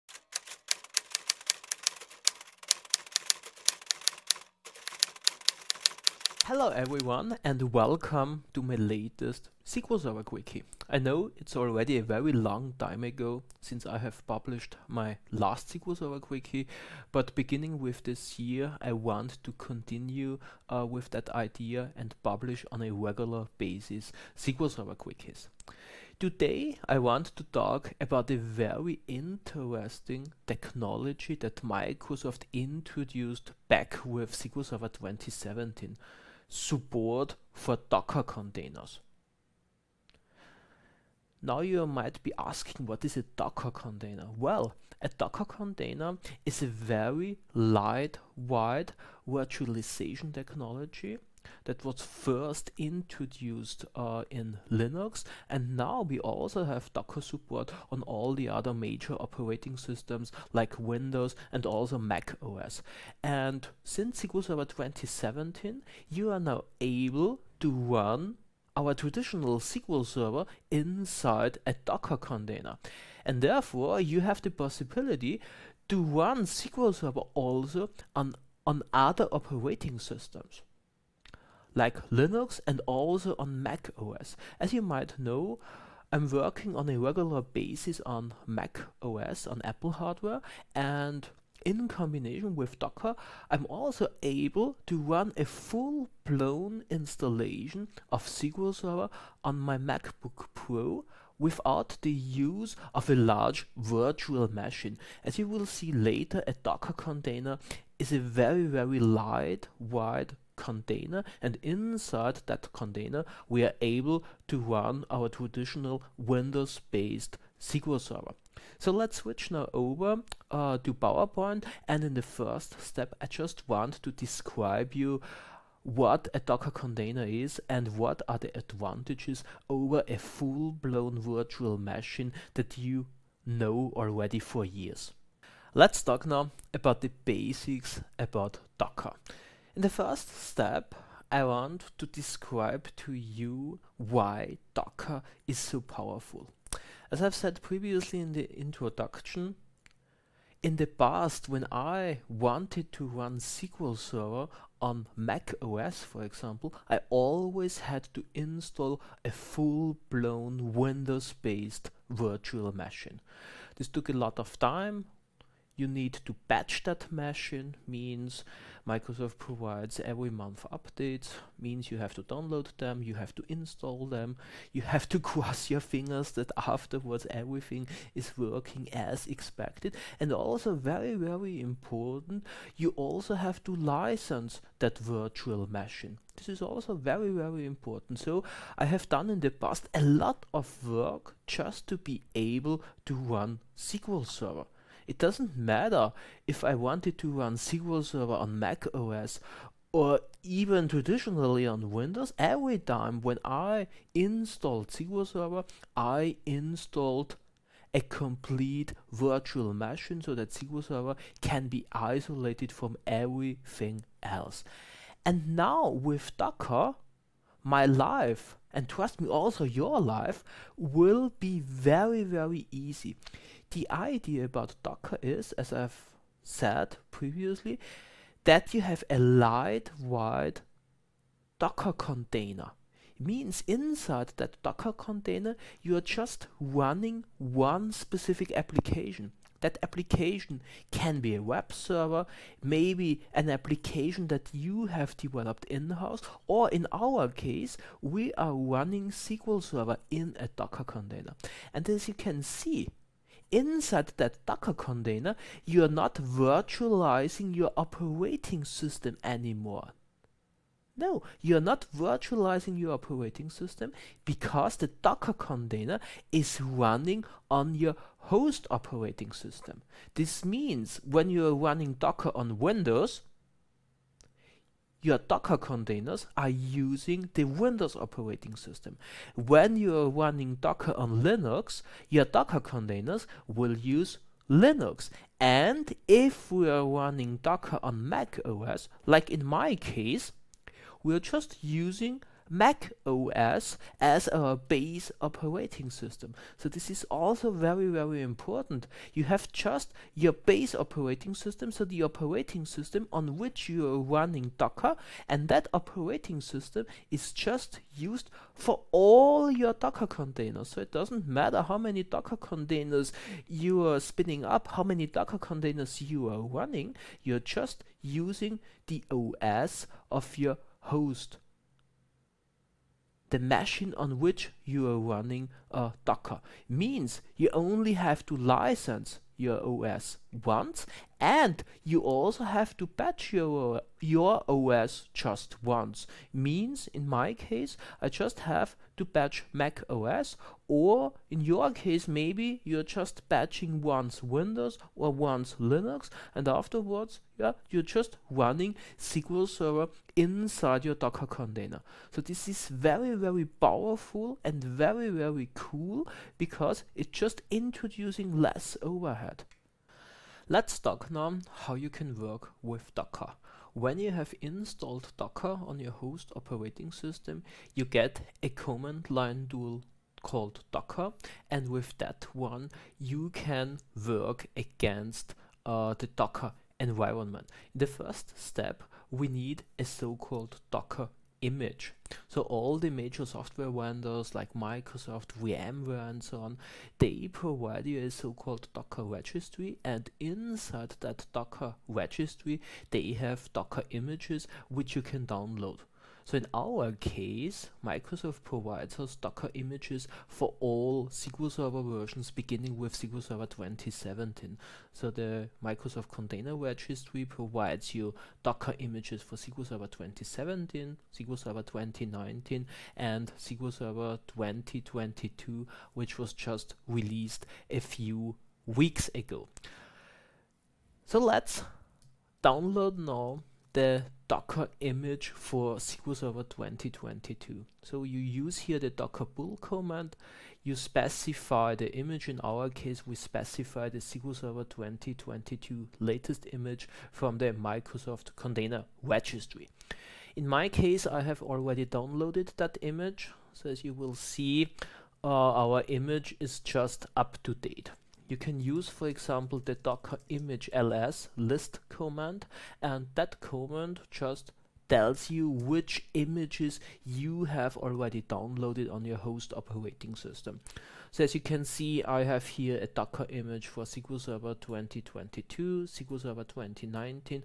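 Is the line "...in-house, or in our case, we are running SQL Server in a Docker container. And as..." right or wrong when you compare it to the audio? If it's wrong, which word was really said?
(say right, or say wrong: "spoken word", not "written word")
right.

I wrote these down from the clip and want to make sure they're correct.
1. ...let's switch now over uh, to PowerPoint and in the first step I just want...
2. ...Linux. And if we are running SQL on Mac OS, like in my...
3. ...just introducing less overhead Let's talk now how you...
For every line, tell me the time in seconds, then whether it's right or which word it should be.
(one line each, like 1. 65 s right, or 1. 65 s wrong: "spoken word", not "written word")
1. 118 s right
2. 284 s wrong: "Docker", not "SQL"
3. 357 s right.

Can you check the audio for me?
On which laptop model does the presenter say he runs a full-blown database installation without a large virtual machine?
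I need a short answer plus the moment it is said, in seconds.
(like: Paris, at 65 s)
MacBook Pro, at 99 s.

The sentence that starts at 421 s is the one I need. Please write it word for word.
So let's download now the Docker image for SQL Server 2022.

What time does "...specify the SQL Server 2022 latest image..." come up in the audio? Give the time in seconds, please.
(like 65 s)
433 s.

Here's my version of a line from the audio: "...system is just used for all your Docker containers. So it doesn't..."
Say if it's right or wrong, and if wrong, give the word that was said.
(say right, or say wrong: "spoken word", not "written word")
right.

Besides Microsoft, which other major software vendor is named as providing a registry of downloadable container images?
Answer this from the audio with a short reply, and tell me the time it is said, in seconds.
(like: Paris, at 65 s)
VMware, at 385 s.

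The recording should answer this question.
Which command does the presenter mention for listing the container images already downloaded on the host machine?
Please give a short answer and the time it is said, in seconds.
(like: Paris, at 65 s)
docker image ls, at 449 s.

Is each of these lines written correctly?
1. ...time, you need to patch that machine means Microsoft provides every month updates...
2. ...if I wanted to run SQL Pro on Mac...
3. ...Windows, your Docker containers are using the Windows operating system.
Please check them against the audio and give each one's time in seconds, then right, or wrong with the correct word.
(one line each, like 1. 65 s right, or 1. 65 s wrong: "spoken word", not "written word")
1. 164 s right
2. 196 s wrong: "Server", not "Pro"
3. 272 s right.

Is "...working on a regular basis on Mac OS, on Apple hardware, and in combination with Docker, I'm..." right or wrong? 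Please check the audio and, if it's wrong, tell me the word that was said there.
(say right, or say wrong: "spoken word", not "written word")
right.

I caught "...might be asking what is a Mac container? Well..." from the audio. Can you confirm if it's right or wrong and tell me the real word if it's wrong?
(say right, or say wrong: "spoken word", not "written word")
wrong: "Docker", not "Mac".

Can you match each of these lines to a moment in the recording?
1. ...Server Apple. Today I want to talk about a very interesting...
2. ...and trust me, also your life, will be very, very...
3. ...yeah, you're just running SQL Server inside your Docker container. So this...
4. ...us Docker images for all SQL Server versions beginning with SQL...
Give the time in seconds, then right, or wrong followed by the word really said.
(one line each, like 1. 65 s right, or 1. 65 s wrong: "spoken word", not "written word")
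1. 24 s wrong: "Quickies", not "Apple"
2. 218 s right
3. 347 s right
4. 399 s right.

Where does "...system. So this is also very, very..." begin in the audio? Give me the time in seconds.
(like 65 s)
295 s.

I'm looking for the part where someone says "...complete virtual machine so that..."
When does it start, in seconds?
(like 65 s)
208 s.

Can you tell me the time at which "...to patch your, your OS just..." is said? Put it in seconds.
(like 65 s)
332 s.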